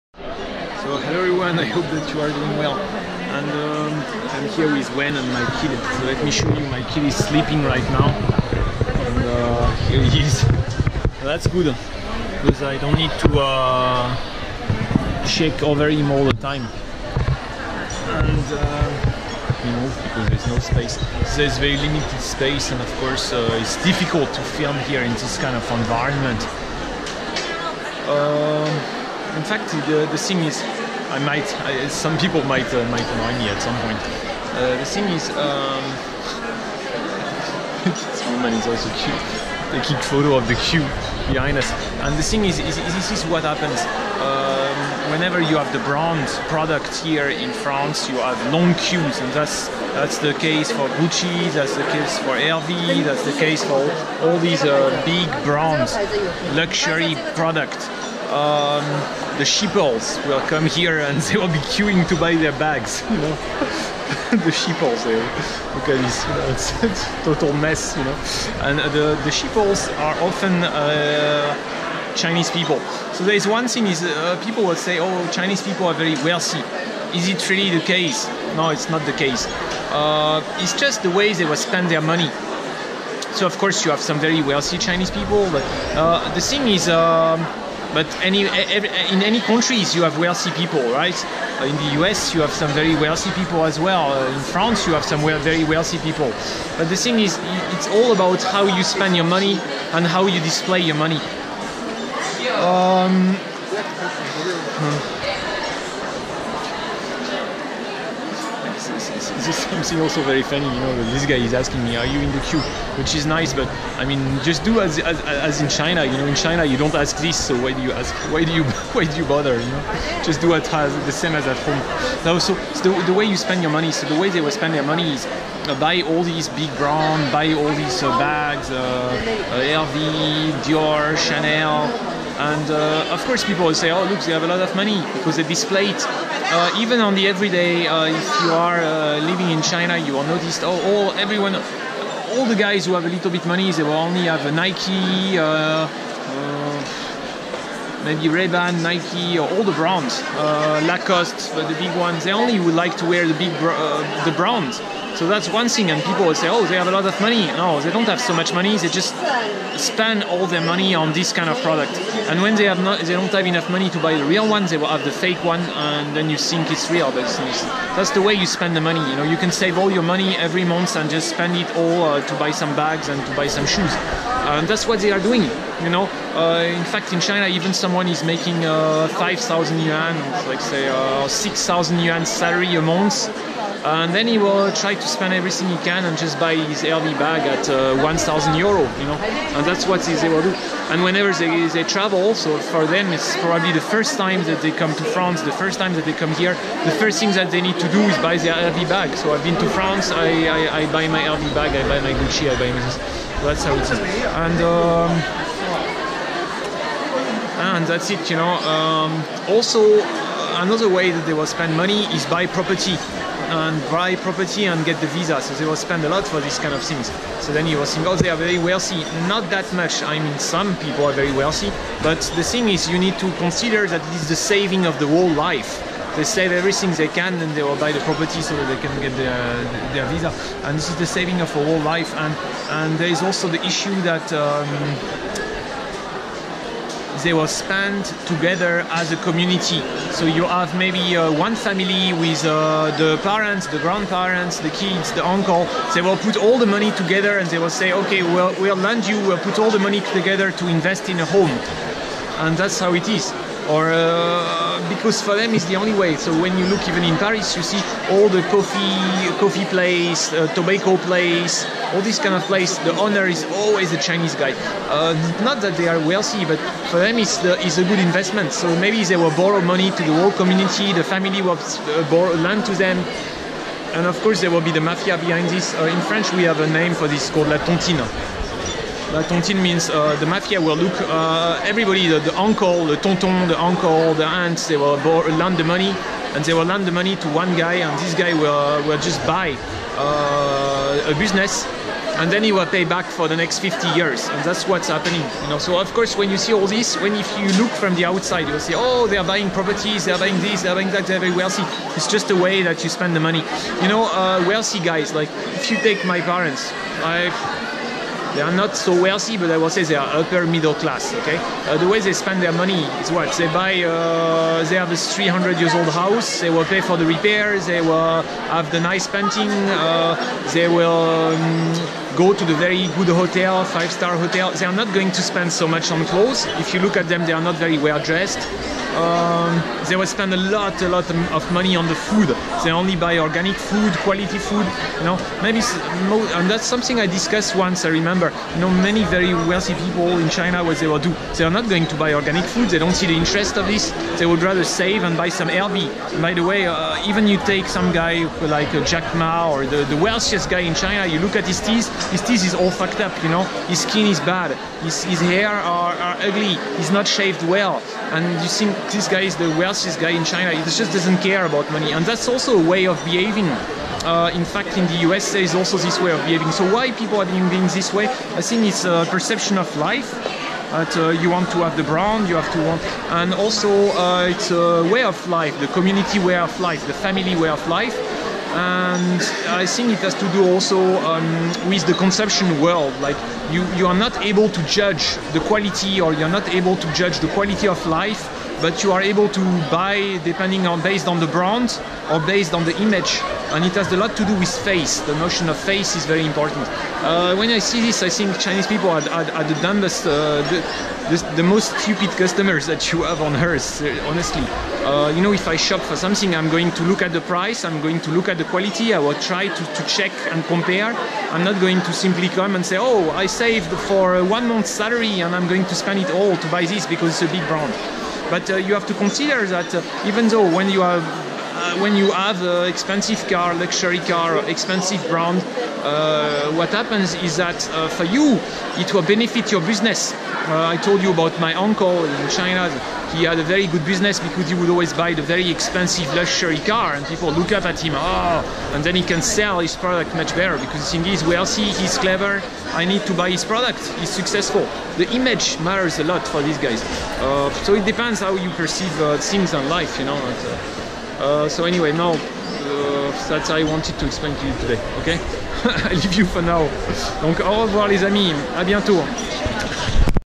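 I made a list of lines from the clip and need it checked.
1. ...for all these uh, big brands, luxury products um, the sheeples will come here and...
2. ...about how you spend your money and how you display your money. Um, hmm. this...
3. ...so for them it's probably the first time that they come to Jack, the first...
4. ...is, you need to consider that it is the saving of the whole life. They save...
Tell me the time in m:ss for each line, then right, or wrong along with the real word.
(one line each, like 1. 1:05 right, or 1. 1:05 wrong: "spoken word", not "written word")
1. 0:53 right
2. 1:38 right
3. 3:12 wrong: "France", not "Jack"
4. 3:42 right.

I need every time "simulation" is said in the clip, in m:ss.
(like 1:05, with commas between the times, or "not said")
not said.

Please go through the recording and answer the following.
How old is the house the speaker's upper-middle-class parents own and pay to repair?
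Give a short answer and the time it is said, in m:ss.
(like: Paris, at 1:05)
300 years, at 5:14.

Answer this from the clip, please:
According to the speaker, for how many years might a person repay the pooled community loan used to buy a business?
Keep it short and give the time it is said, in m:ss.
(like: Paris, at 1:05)
50 years, at 4:53.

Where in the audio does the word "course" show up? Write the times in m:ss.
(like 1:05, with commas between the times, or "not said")
0:22, 1:23, 2:13, 4:34, 4:55.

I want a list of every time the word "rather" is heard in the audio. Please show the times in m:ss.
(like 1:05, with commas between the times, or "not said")
5:44.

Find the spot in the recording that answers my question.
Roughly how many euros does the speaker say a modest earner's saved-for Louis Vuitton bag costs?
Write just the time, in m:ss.
3:08.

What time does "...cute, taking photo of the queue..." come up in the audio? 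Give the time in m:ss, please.
0:38.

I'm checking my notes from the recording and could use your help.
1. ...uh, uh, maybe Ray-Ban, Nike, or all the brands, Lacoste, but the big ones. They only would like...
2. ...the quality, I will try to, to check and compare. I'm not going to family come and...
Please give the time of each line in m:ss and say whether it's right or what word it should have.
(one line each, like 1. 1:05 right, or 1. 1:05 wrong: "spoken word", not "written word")
1. 2:25 right
2. 6:48 wrong: "simply", not "family".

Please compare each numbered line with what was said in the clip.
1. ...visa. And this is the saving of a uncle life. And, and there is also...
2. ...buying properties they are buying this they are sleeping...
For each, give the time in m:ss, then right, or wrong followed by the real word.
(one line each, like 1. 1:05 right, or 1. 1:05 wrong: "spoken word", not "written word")
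1. 3:50 wrong: "whole", not "uncle"
2. 4:59 wrong: "buying", not "sleeping".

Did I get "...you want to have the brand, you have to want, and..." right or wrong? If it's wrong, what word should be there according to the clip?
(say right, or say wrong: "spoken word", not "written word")
right.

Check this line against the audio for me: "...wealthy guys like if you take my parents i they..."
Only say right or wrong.
right.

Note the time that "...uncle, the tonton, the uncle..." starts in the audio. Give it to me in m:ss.
4:42.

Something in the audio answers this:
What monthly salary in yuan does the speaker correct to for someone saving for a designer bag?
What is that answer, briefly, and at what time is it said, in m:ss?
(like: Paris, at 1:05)
6,000 yuan, at 3:01.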